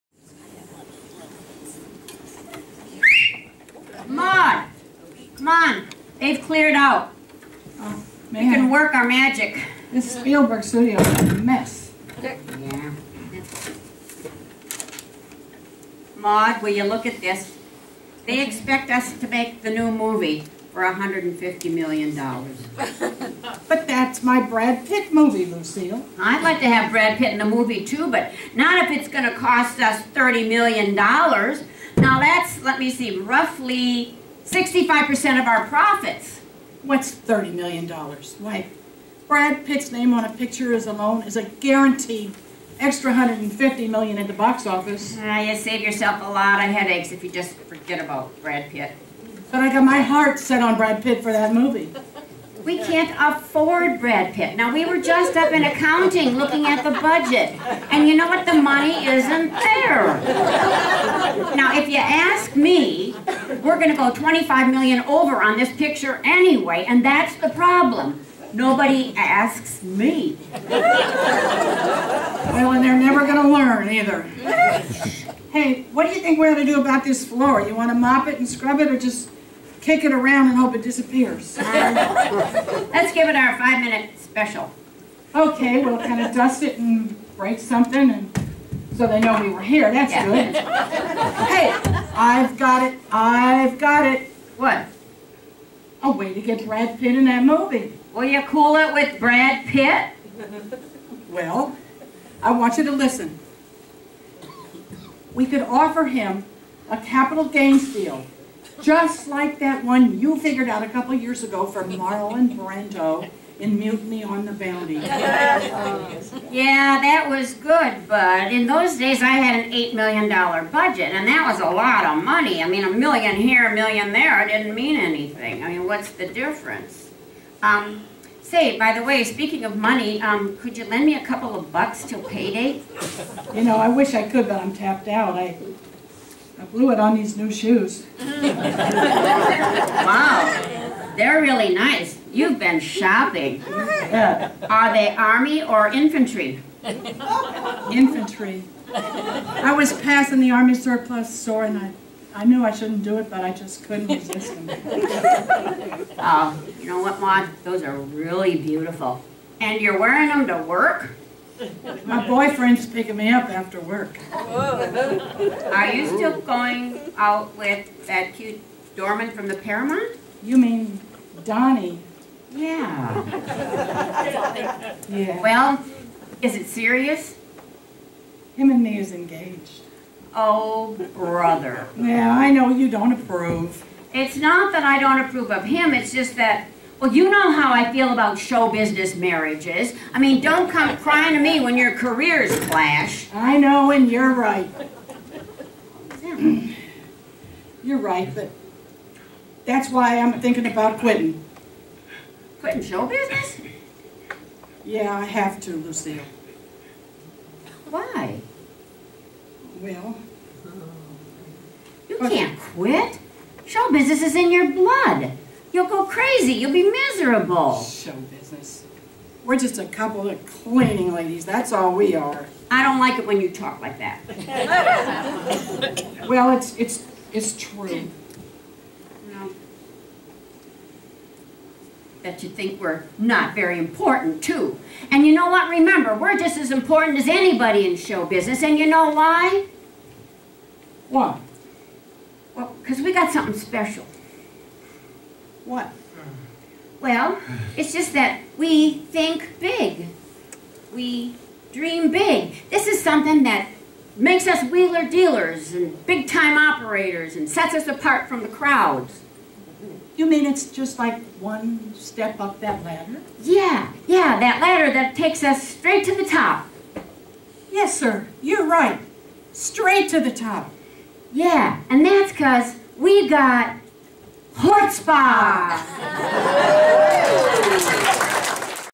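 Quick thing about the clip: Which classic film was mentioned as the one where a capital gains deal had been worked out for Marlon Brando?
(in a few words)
Mutiny on the Bounty.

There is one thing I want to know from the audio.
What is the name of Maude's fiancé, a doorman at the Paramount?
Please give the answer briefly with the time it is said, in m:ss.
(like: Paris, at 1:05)
Donnie, at 2:51.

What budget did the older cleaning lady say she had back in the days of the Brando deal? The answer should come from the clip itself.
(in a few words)
$8 million.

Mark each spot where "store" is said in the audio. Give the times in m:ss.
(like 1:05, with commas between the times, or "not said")
2:31.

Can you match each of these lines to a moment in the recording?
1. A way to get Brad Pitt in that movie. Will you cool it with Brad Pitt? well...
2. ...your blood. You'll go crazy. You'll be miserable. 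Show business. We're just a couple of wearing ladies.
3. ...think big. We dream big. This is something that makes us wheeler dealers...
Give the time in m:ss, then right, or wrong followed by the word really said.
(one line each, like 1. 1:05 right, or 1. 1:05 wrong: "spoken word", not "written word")
1. 1:36 right
2. 3:34 wrong: "cleaning", not "wearing"
3. 4:08 right.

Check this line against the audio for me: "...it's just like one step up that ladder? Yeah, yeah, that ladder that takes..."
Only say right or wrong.
right.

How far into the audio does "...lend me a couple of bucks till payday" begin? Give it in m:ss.
2:10.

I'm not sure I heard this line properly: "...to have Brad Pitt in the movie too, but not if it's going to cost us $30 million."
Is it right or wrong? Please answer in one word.
right.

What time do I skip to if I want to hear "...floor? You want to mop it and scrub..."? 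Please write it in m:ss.
1:17.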